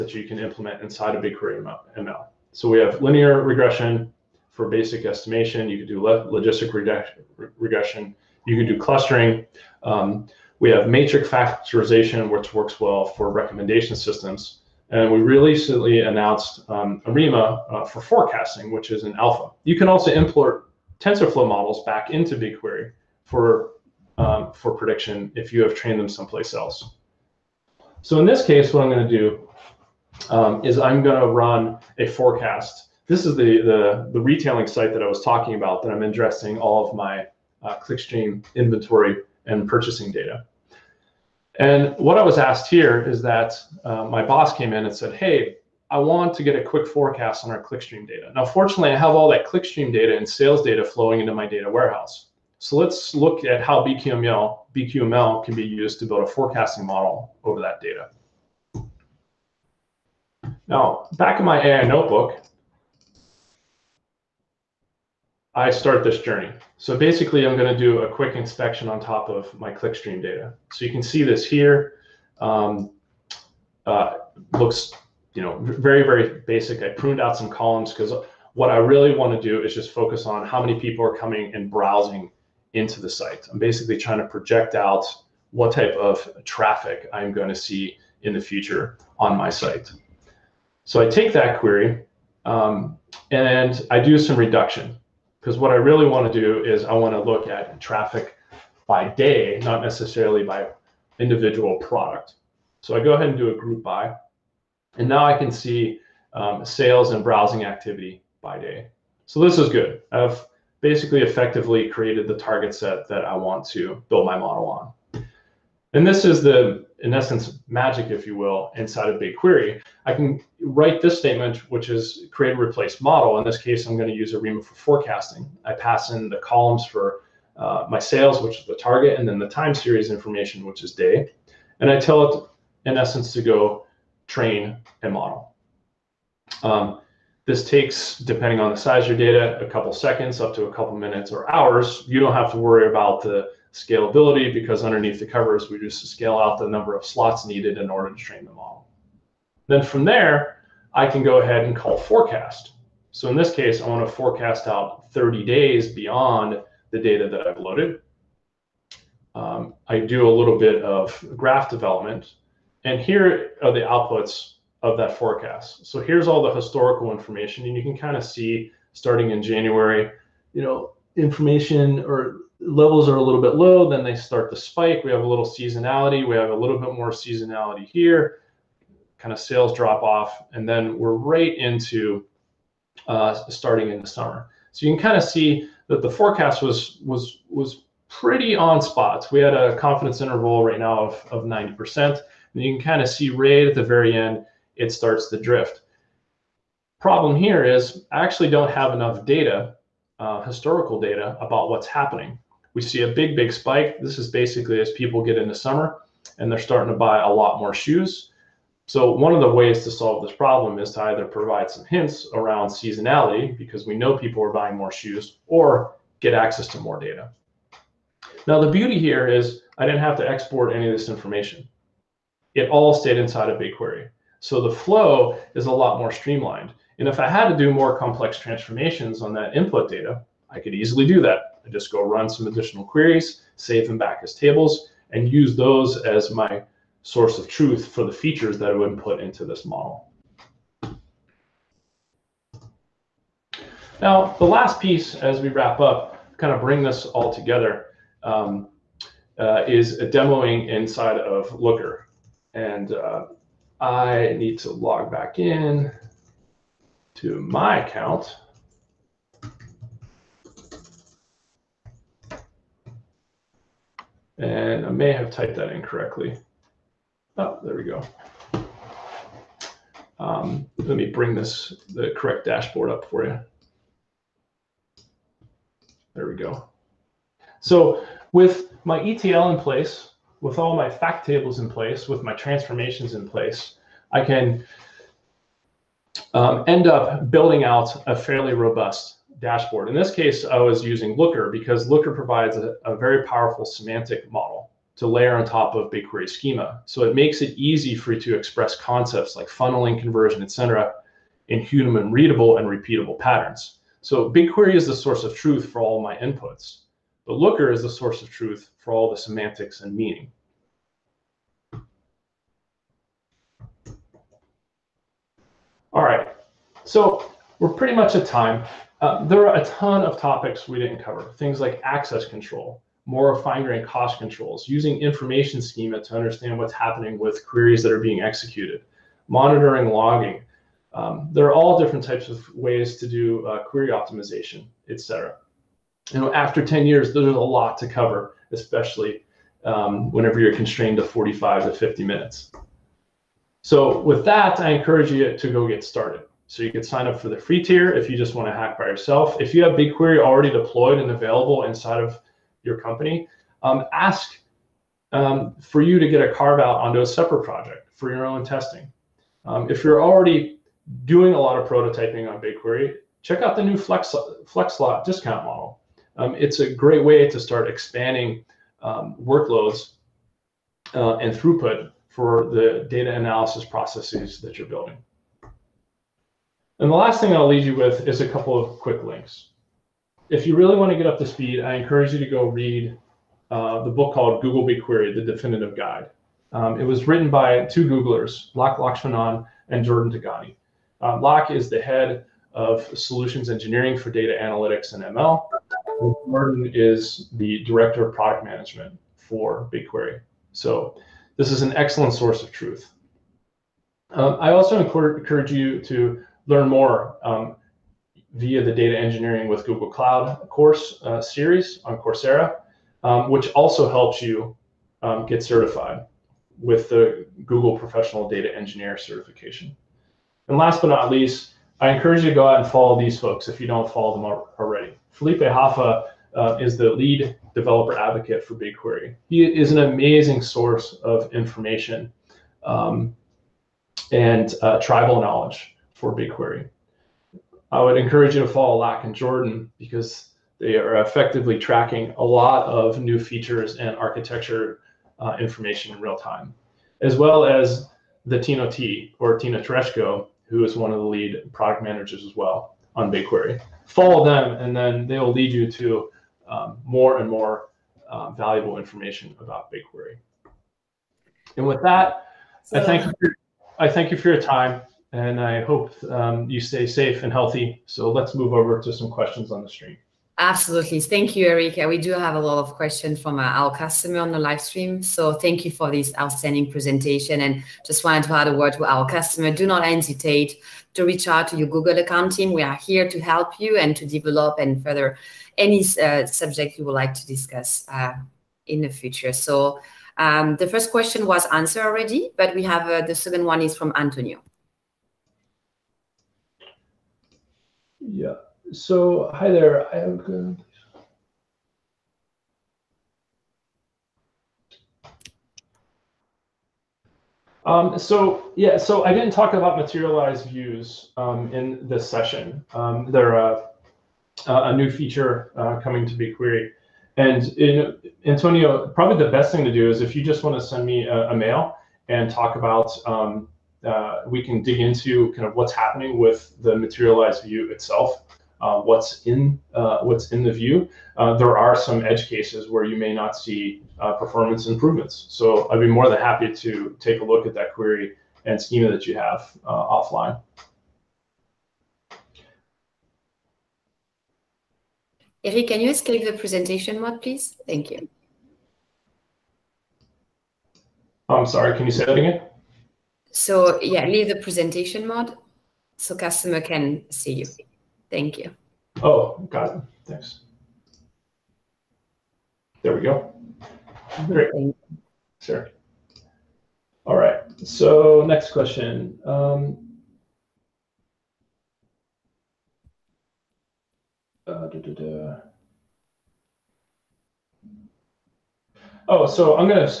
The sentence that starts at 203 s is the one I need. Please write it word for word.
This is basically as people get into summer and they're starting to buy a lot more shoes.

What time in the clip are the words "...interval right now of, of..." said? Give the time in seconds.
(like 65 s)
190 s.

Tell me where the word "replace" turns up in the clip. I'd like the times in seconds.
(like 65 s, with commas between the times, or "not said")
122 s.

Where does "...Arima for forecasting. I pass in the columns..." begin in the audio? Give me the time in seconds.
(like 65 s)
124 s.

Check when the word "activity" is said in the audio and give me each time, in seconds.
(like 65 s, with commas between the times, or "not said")
107 s.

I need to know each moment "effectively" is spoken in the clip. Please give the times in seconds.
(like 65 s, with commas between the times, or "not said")
111 s, 441 s.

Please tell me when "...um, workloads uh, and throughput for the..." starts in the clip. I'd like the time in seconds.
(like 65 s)
368 s.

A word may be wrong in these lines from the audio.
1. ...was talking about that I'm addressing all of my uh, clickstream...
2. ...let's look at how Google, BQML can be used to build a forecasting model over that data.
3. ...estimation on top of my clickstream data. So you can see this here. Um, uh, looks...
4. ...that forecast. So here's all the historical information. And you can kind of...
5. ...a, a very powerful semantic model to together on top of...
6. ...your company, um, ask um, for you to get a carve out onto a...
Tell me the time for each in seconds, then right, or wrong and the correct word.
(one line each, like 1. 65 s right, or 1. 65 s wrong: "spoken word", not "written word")
1. 35 s right
2. 52 s wrong: "BQML", not "Google"
3. 68 s wrong: "inspection", not "estimation"
4. 164 s right
5. 292 s wrong: "layer", not "together"
6. 352 s right.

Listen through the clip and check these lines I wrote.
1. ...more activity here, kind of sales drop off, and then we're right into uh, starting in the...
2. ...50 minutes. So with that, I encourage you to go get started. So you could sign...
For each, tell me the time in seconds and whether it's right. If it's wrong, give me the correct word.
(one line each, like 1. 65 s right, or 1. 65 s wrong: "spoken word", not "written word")
1. 176 s wrong: "seasonality", not "activity"
2. 341 s right.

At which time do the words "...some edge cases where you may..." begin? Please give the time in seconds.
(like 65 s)
531 s.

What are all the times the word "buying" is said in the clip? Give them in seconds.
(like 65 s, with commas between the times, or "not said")
214 s.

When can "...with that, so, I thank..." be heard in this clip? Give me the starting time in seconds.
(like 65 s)
461 s.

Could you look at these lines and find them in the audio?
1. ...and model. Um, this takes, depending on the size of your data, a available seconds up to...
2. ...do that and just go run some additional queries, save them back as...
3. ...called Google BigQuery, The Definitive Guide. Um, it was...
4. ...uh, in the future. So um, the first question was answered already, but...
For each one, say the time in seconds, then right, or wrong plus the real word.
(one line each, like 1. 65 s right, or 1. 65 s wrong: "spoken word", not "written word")
1. 135 s wrong: "couple", not "available"
2. 231 s right
3. 384 s right
4. 487 s right.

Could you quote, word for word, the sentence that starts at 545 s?
Eric, can you escape the presentation mode, please?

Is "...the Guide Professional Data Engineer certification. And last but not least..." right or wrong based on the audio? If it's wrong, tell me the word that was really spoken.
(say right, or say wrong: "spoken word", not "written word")
wrong: "Google", not "Guide".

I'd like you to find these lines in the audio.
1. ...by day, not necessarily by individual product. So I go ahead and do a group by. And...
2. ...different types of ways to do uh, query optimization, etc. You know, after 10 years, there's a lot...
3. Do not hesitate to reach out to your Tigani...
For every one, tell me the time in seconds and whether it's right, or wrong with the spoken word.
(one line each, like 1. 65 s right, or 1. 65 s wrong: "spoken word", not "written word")
1. 98 s right
2. 331 s right
3. 479 s wrong: "Google", not "Tigani".